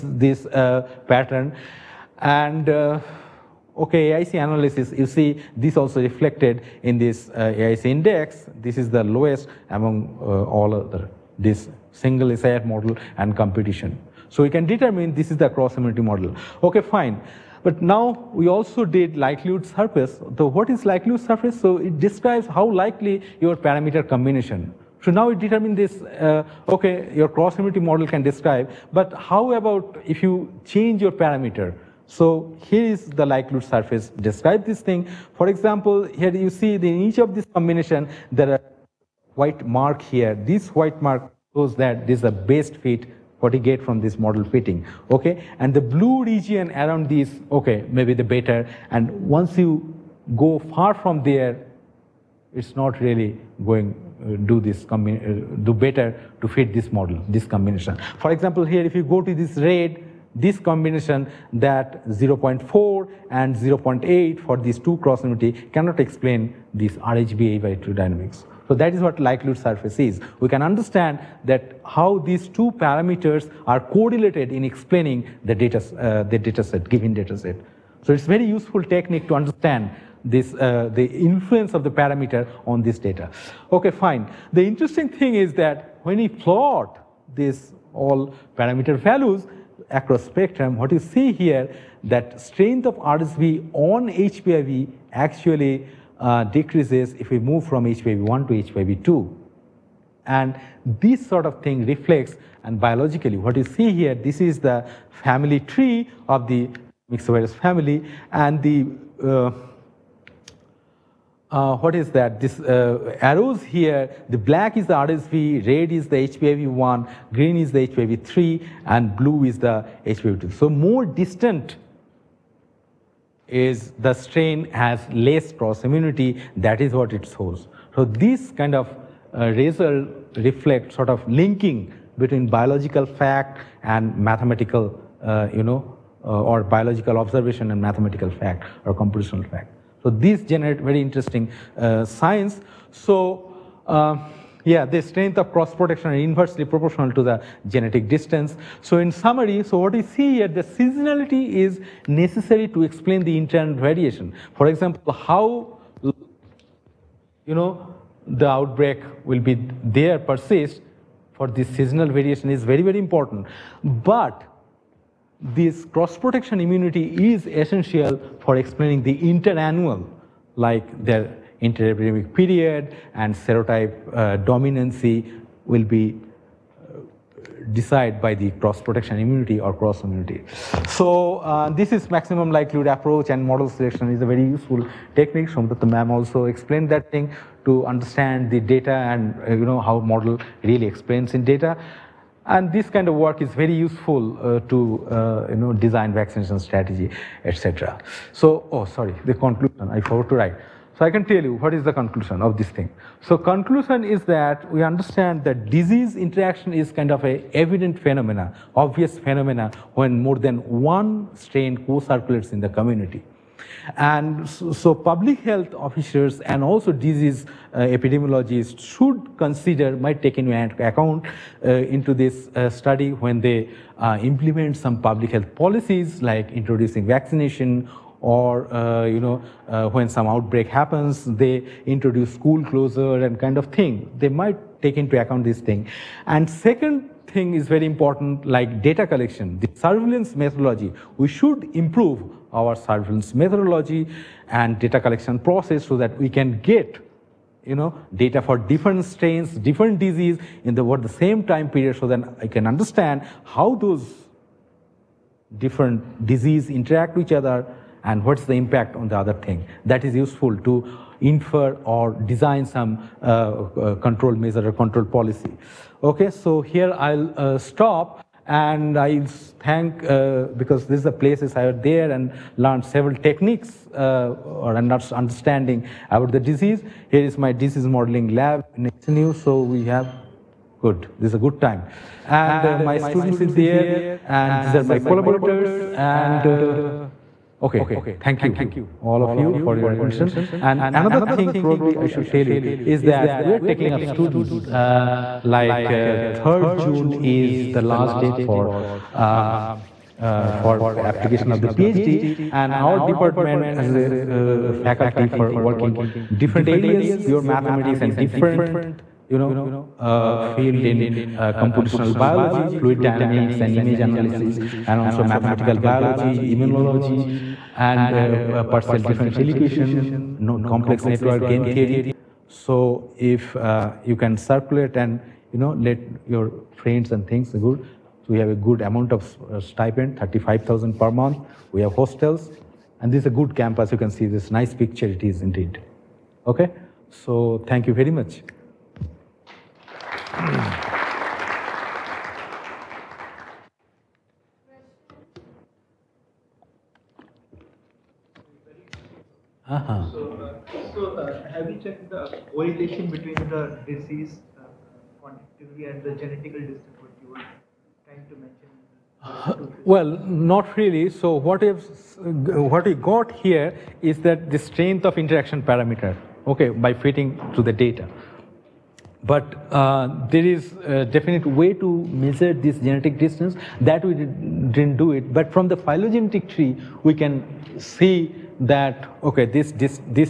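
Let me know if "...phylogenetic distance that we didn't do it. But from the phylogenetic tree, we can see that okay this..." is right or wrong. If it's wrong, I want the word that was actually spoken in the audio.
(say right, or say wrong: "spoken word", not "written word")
wrong: "genetic", not "phylogenetic".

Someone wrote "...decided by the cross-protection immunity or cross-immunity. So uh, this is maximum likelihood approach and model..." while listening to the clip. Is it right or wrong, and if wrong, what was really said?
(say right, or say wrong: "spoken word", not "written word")
right.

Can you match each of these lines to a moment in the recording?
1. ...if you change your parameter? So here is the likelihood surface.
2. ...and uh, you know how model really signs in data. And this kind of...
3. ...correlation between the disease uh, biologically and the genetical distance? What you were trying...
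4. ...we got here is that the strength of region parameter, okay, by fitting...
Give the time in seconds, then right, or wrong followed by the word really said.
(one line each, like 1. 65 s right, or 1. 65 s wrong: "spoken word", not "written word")
1. 30 s right
2. 188 s wrong: "explains", not "signs"
3. 352 s wrong: "quantitatively", not "biologically"
4. 362 s wrong: "interaction", not "region".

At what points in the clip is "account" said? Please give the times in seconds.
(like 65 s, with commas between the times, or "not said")
220 s, 235 s.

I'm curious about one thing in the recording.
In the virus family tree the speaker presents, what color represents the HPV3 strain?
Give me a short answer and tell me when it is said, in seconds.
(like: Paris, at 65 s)
Green, at 117 s.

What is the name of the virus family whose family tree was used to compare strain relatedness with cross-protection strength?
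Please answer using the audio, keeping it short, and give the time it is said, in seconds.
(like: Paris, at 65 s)
Myxovirus, at 107 s.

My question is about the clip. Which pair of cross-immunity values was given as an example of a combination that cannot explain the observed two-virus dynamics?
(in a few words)
0.4 and 0.8.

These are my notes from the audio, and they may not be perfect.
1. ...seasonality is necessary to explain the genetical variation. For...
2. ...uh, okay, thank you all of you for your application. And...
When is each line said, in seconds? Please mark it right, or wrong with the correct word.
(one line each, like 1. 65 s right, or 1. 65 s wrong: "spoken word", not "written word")
1. 150 s wrong: "internal", not "genetical"
2. 286 s wrong: "attention", not "application".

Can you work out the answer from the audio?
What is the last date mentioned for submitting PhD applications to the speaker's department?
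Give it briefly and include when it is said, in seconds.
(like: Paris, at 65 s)
3rd June, at 296 s.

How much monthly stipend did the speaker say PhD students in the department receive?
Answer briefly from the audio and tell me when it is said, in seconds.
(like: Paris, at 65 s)
35,000, at 330 s.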